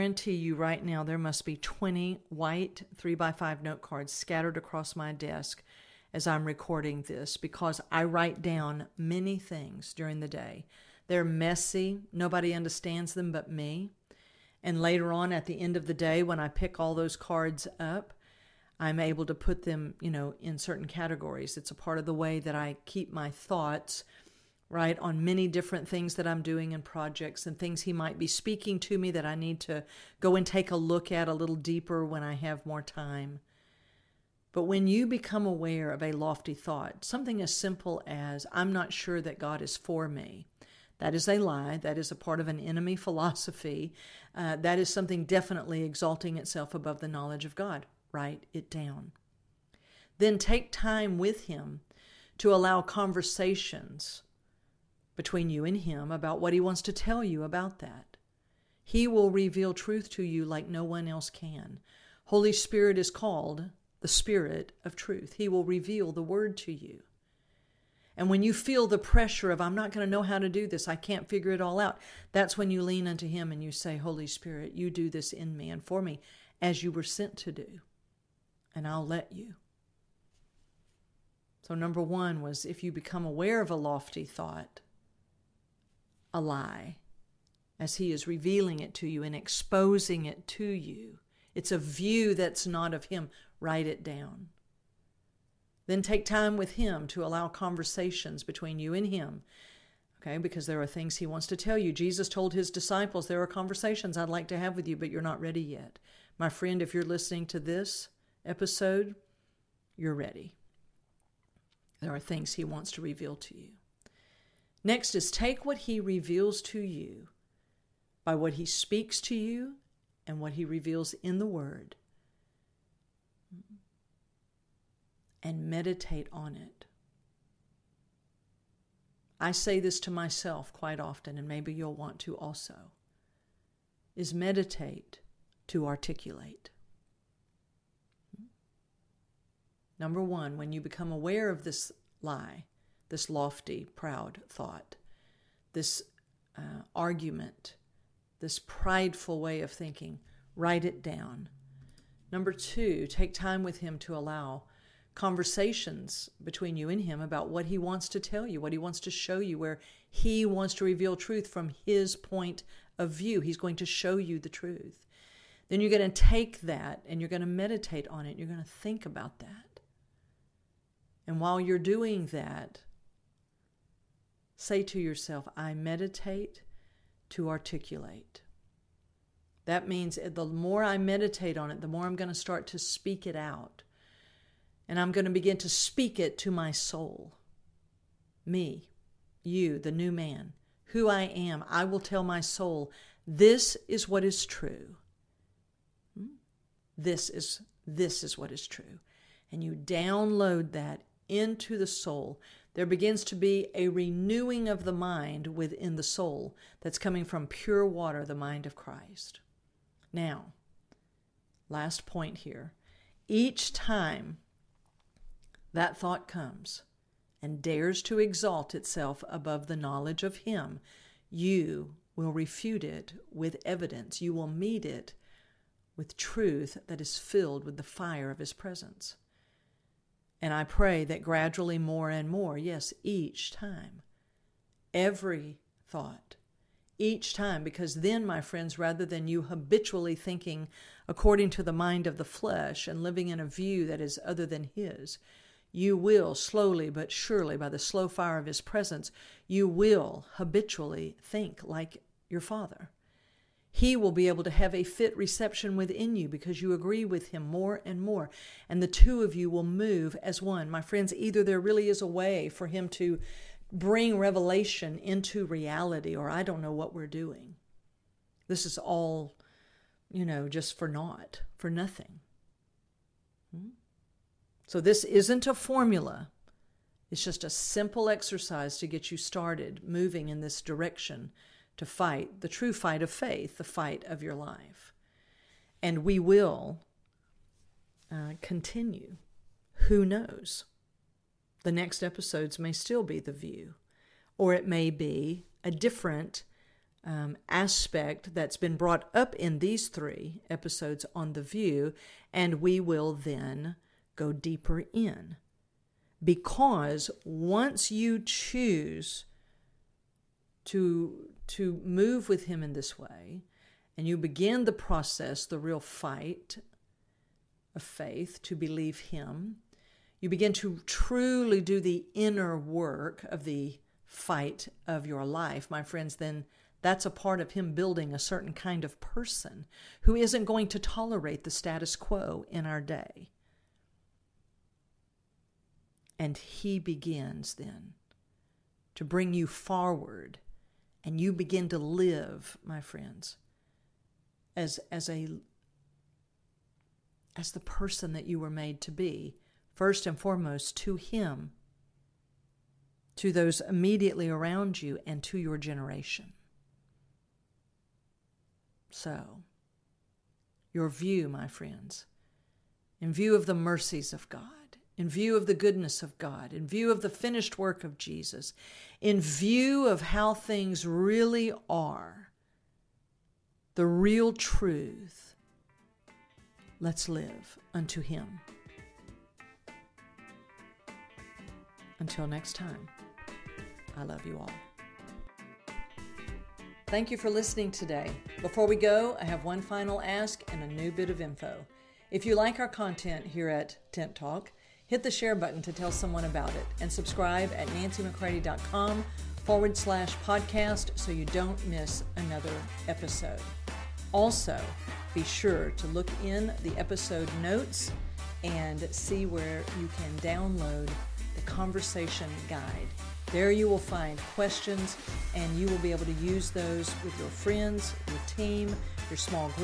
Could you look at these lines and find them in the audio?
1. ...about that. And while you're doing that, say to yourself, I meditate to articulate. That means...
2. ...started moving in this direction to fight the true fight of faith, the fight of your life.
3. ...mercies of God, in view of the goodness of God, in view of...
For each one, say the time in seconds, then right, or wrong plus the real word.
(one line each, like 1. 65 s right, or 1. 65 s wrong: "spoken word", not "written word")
1. 169 s right
2. 279 s right
3. 363 s right.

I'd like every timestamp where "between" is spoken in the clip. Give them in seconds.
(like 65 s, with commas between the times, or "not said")
55 s, 98 s, 156 s.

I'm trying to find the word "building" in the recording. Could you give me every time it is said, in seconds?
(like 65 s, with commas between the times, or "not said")
327 s.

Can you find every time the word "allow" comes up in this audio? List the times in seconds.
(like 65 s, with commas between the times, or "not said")
52 s, 97 s, 154 s.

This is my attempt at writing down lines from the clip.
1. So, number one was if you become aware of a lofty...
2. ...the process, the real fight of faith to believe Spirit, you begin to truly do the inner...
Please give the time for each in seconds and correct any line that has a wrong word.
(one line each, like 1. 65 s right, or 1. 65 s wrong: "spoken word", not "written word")
1. 81 s right
2. 314 s wrong: "Him", not "Spirit".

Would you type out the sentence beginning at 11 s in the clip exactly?
They're messy, nobody understands them but me.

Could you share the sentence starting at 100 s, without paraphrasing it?
Okay, because there are things he wants to tell you.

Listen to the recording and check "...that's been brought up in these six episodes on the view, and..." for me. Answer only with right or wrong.
wrong.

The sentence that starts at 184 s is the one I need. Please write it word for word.
And I'm going to begin to speak it to my soul.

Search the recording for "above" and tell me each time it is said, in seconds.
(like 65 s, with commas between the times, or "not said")
46 s, 219 s.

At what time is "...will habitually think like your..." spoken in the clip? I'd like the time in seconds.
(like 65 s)
249 s.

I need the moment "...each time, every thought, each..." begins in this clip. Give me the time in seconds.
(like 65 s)
233 s.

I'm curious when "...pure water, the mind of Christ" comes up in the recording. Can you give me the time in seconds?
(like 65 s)
207 s.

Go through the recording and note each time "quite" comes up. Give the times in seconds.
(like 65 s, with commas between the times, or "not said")
130 s.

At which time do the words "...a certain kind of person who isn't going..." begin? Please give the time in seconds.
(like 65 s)
328 s.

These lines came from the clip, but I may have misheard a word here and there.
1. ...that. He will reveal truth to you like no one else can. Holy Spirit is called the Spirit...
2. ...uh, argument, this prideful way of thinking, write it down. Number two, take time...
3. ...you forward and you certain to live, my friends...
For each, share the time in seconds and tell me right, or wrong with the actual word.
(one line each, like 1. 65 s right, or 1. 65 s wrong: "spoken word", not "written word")
1. 57 s right
2. 146 s right
3. 339 s wrong: "begin", not "certain".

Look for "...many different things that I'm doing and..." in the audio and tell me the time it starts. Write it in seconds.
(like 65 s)
25 s.